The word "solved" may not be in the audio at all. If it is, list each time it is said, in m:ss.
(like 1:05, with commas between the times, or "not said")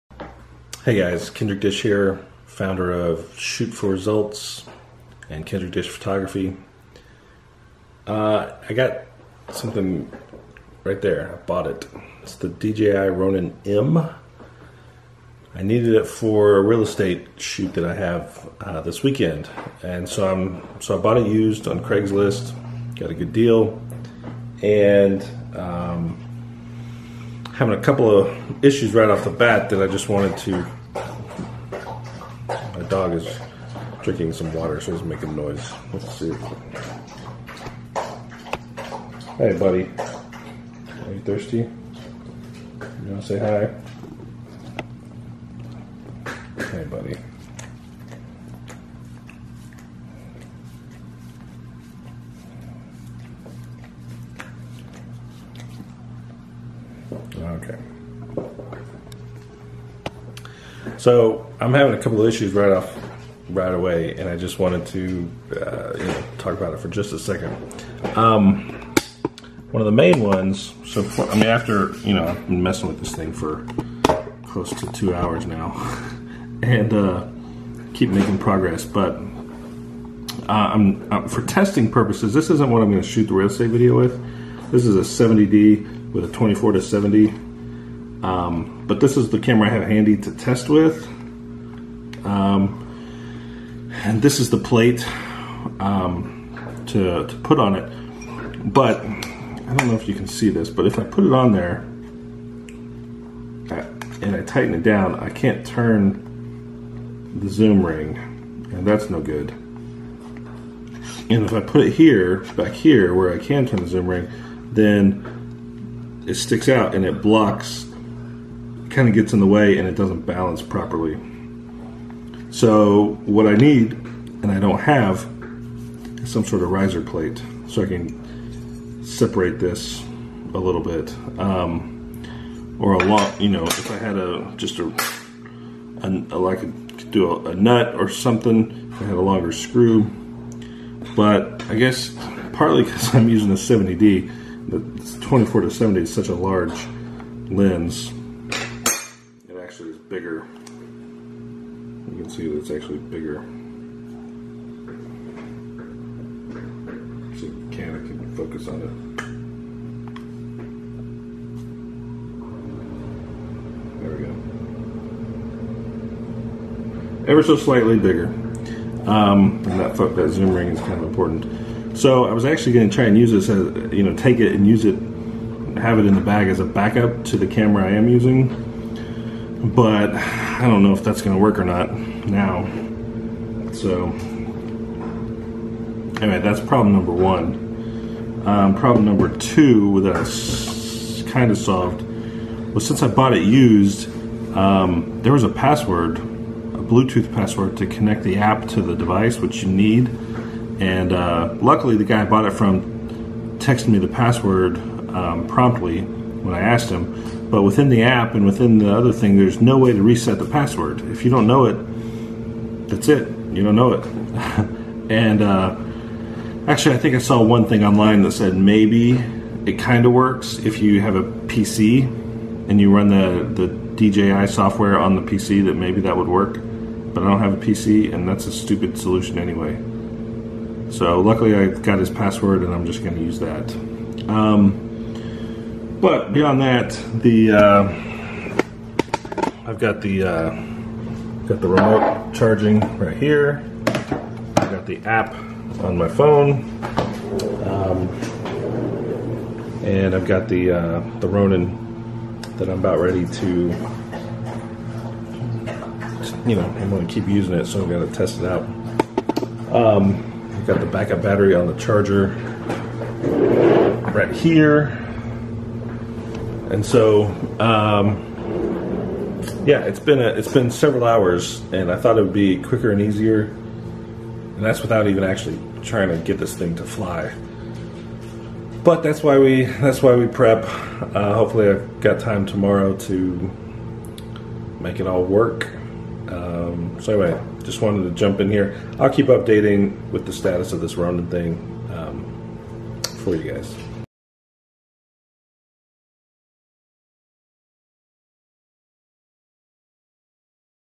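3:11.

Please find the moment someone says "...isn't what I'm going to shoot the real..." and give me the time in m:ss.
1:22.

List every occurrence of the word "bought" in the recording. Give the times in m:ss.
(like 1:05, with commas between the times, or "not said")
0:11, 0:20, 3:13, 3:22.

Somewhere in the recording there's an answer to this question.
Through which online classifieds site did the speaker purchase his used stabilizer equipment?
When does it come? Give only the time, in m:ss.
0:21.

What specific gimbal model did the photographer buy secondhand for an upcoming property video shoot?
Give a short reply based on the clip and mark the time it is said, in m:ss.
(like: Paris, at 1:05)
DJI Ronin M, at 0:12.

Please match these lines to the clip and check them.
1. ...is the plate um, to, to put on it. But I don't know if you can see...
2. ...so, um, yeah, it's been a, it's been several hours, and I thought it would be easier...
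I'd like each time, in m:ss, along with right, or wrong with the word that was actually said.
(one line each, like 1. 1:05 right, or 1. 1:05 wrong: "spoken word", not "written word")
1. 1:34 right
2. 4:26 wrong: "quicker", not "easier".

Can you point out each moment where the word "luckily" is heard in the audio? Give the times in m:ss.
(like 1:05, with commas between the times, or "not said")
3:21, 3:51.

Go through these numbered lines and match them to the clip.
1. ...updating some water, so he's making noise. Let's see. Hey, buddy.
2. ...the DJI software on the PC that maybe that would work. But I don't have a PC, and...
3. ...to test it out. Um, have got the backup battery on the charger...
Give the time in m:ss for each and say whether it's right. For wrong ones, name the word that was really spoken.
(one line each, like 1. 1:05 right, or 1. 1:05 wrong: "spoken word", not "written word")
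1. 0:34 wrong: "drinking", not "updating"
2. 3:43 right
3. 4:17 right.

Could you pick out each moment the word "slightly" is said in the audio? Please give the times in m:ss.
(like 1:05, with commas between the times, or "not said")
2:47.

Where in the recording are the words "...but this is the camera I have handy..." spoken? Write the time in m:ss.
1:28.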